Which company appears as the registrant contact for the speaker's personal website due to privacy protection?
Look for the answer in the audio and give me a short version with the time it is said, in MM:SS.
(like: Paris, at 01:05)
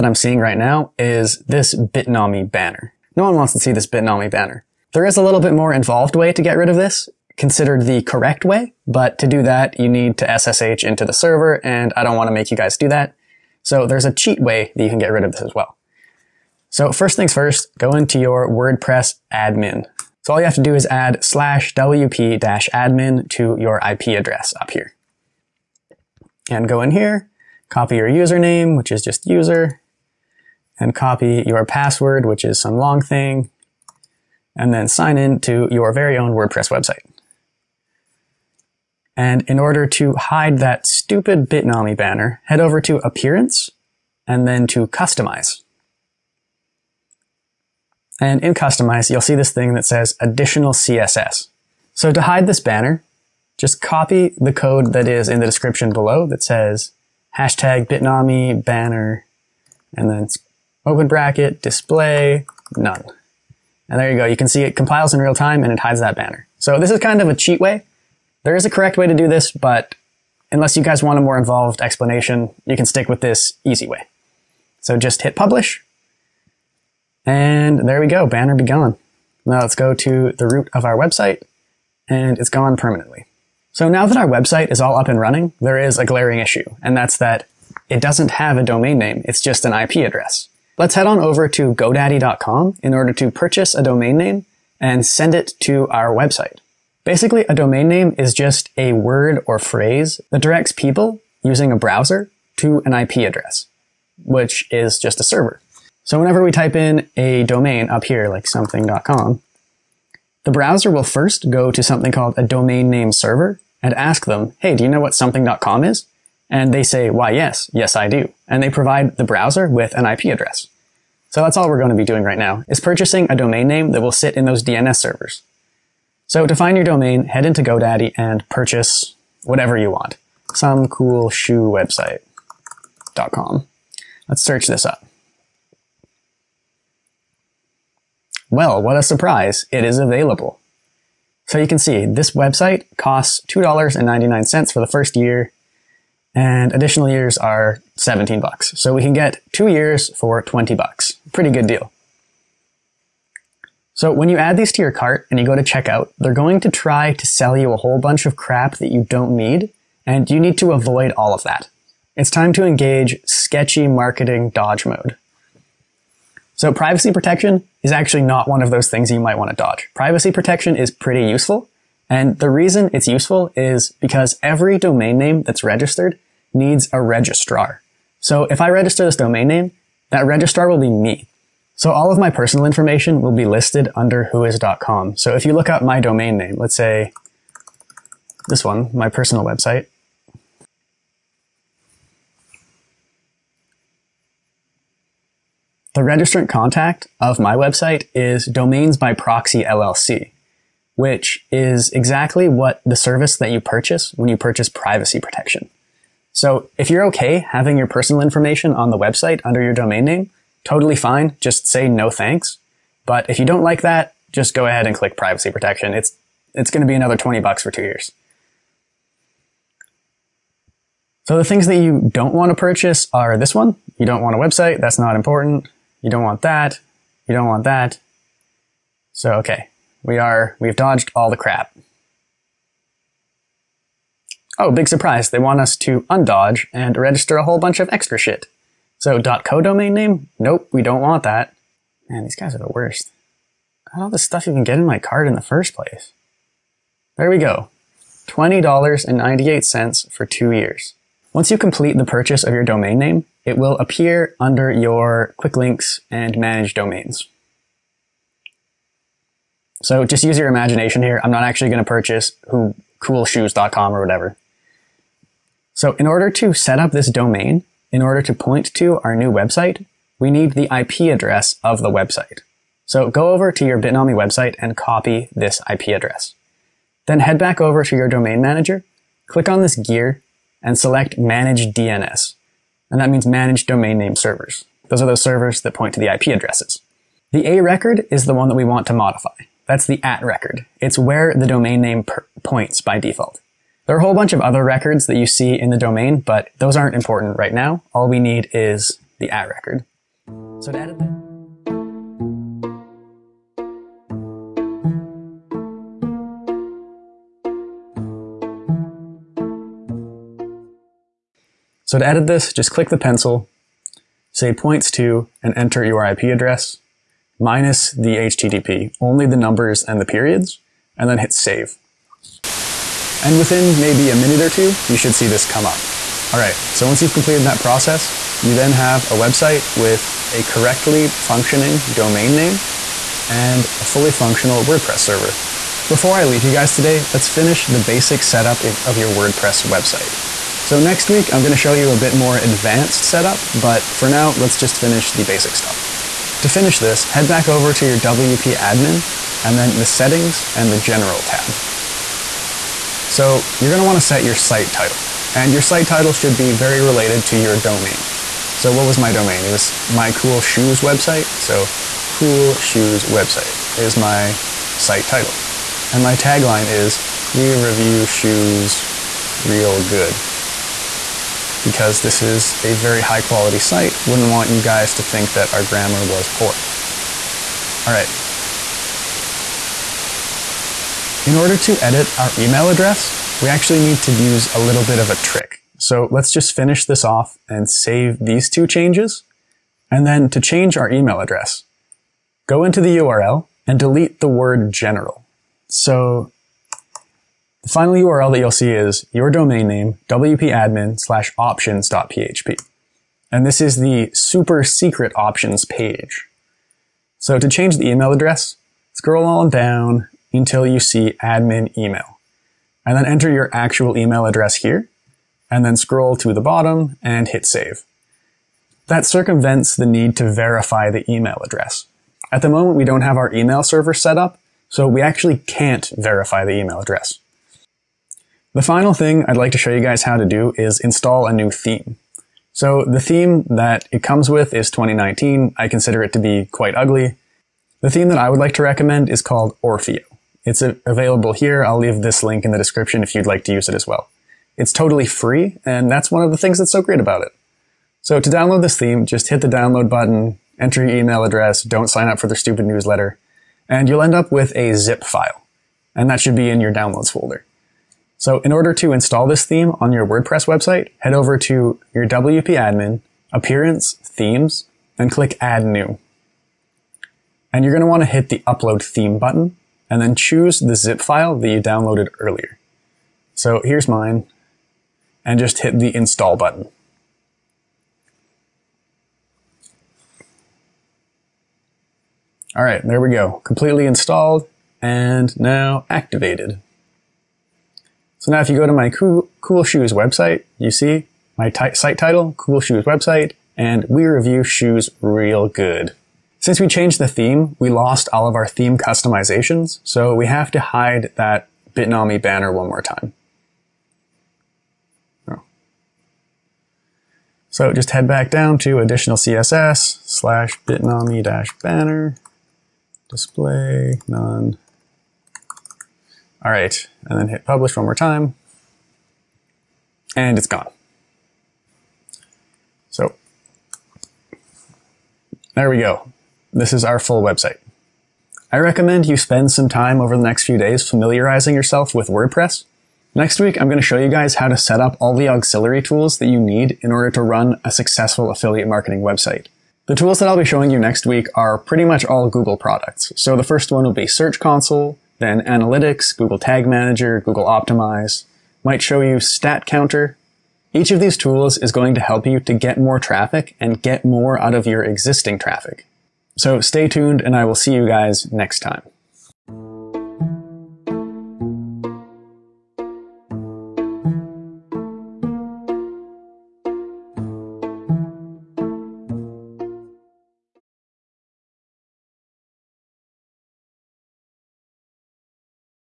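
Domains by Proxy LLC, at 03:18.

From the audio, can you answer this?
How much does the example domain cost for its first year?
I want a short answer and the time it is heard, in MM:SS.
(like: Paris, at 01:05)
$2.99, at 02:23.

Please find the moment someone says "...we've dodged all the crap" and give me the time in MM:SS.
03:50.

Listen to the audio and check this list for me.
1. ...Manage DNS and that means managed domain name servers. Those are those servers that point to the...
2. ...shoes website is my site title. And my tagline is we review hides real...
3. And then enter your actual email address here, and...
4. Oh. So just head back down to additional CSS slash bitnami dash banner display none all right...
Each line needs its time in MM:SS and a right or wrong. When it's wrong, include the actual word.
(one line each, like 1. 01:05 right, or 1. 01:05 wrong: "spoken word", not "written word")
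1. 04:41 right
2. 06:02 wrong: "shoes", not "hides"
3. 06:52 right
4. 08:25 right.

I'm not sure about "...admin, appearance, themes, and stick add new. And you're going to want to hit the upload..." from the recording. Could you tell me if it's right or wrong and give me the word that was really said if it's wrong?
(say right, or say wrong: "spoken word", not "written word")
wrong: "click", not "stick".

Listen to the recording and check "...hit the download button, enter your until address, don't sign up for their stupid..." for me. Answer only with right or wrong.
wrong.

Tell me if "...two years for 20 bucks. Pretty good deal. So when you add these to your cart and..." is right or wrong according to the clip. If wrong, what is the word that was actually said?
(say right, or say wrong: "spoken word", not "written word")
right.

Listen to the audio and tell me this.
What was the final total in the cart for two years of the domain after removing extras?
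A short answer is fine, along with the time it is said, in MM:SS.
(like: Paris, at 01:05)
$20.98, at 04:08.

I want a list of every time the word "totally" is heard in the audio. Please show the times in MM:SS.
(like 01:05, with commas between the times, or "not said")
03:30, 07:24.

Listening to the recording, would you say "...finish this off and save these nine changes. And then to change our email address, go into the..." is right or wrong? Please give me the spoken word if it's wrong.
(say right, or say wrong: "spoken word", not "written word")
wrong: "two", not "nine".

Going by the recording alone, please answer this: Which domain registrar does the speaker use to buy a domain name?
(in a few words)
GoDaddy.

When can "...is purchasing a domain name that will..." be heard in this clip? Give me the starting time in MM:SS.
02:02.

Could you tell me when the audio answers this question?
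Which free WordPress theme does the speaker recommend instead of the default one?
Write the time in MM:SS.
07:19.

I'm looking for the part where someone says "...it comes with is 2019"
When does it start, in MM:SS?
07:13.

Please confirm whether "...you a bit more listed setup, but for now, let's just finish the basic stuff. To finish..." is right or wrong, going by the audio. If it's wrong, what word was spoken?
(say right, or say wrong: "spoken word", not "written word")
wrong: "advanced", not "listed".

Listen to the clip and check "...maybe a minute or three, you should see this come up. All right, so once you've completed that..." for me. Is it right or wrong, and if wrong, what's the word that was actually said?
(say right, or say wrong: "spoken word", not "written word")
wrong: "two", not "three".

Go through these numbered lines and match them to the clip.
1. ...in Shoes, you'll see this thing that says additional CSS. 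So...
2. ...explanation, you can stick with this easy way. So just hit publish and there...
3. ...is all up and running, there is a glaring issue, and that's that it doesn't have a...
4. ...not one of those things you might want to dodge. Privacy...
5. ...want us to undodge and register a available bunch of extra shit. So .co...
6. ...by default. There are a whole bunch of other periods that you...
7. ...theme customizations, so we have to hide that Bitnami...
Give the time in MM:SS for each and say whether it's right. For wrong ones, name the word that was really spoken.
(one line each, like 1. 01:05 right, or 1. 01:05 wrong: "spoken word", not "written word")
1. 00:48 wrong: "Customize", not "Shoes"
2. 01:11 right
3. 01:24 right
4. 02:48 right
5. 03:55 wrong: "whole", not "available"
6. 04:52 wrong: "records", not "periods"
7. 08:18 right.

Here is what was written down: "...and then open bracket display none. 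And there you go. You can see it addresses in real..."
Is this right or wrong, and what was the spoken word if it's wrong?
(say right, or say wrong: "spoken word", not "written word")
wrong: "compiles", not "addresses".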